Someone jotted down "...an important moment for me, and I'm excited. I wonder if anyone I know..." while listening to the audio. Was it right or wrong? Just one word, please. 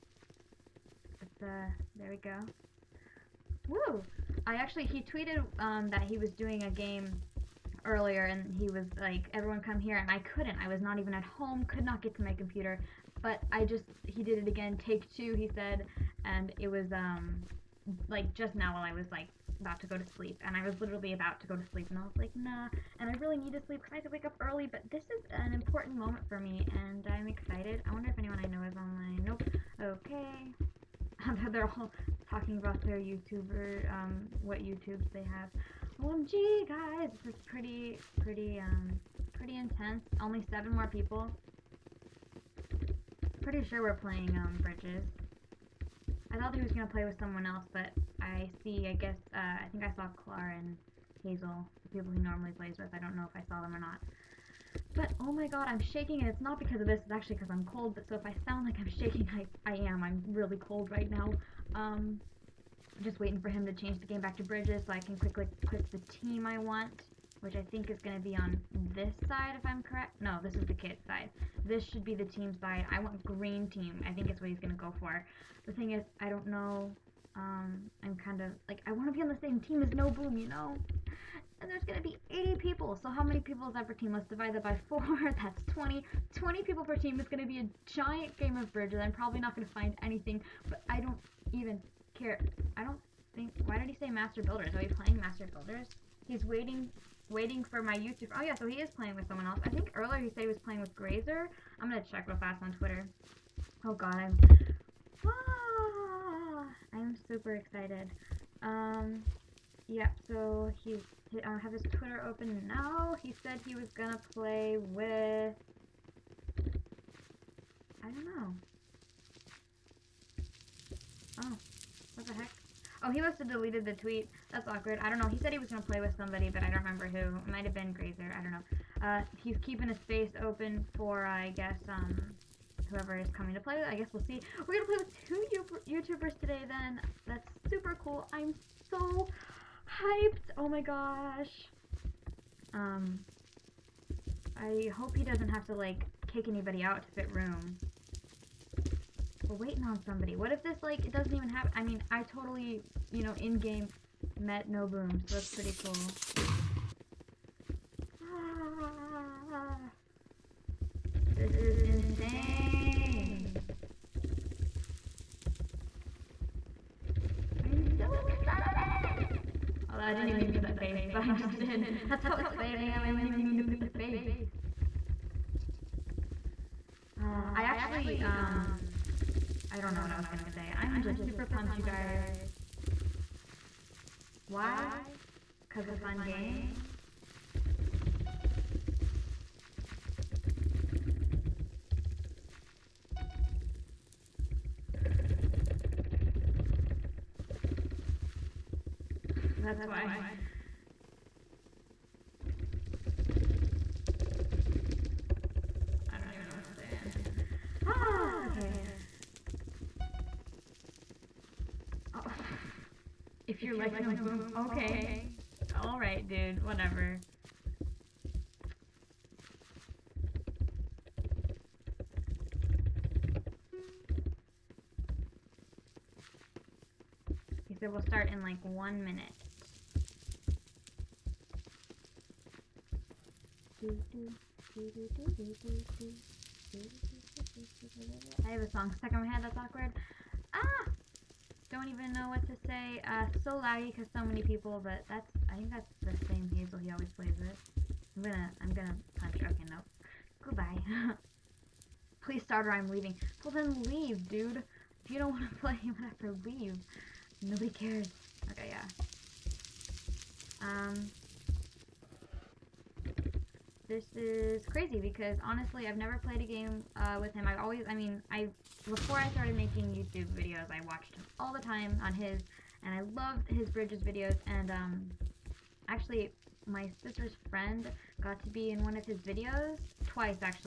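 right.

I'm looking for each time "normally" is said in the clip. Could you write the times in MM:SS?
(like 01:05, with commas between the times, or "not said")
00:52.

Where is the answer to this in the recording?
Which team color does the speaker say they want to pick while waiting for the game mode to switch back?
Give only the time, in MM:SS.
01:13.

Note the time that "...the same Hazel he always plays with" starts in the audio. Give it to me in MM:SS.
04:06.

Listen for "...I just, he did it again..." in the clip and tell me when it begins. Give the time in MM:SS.
00:13.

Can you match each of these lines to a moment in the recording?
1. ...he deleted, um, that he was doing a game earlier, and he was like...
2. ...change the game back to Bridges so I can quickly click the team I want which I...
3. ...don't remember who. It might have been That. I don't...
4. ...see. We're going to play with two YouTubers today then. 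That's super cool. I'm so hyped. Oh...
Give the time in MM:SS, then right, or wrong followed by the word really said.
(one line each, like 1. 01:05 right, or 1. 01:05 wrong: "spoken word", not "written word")
1. 00:04 wrong: "tweeted", not "deleted"
2. 01:03 right
3. 02:06 wrong: "Graser", not "That"
4. 02:14 right.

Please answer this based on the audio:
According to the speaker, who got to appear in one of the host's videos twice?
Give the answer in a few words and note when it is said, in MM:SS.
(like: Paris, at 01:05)
sister's friend, at 04:36.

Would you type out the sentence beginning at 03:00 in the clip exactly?
I'm just super pumped, you guys.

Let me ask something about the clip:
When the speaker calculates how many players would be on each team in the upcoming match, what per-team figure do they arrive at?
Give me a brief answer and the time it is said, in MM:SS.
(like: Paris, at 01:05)
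20, at 01:25.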